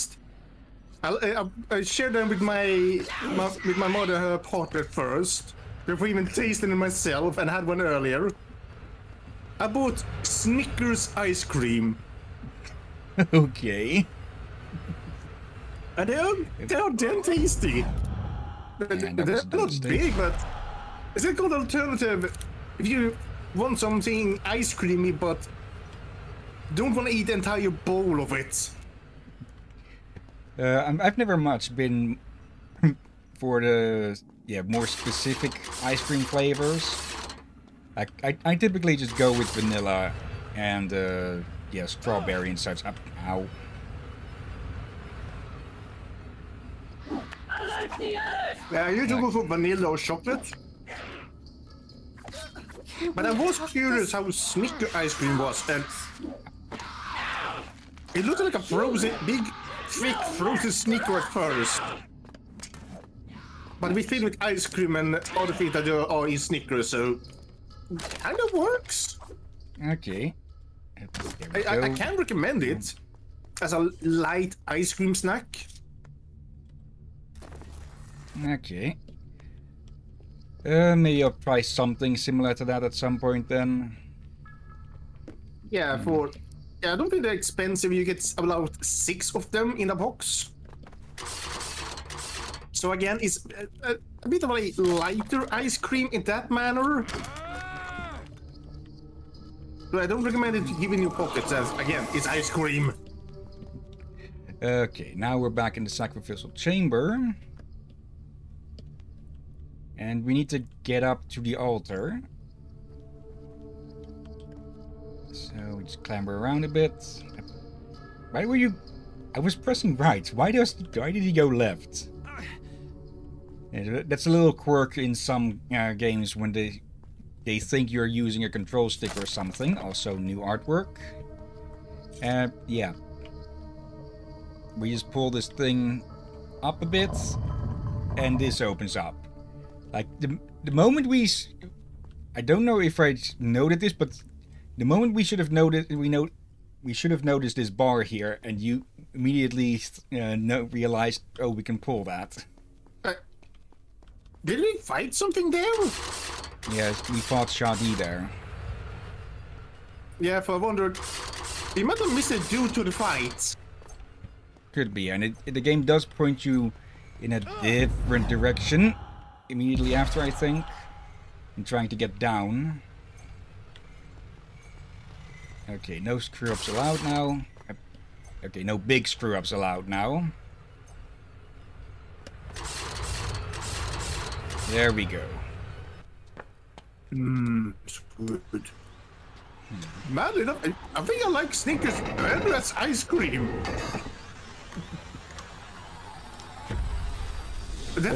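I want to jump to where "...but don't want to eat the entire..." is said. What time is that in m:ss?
0:25.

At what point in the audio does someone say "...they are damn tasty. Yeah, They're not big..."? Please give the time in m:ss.
0:16.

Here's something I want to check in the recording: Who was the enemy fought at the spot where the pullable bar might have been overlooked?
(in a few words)
Shahdee.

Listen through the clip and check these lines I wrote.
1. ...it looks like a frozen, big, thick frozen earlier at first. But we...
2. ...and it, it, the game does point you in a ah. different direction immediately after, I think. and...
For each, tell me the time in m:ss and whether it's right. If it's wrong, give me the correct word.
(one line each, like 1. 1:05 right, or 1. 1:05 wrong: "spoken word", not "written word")
1. 0:58 wrong: "sneaker", not "earlier"
2. 2:45 right.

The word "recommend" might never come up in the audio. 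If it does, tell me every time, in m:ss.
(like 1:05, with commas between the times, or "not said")
1:12, 1:40.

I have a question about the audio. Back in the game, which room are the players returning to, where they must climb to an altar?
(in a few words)
sacrificial chamber.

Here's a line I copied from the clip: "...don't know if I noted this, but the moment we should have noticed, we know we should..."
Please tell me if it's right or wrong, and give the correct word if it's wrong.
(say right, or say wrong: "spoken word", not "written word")
right.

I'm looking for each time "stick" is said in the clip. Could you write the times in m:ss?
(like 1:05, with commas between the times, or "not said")
2:08.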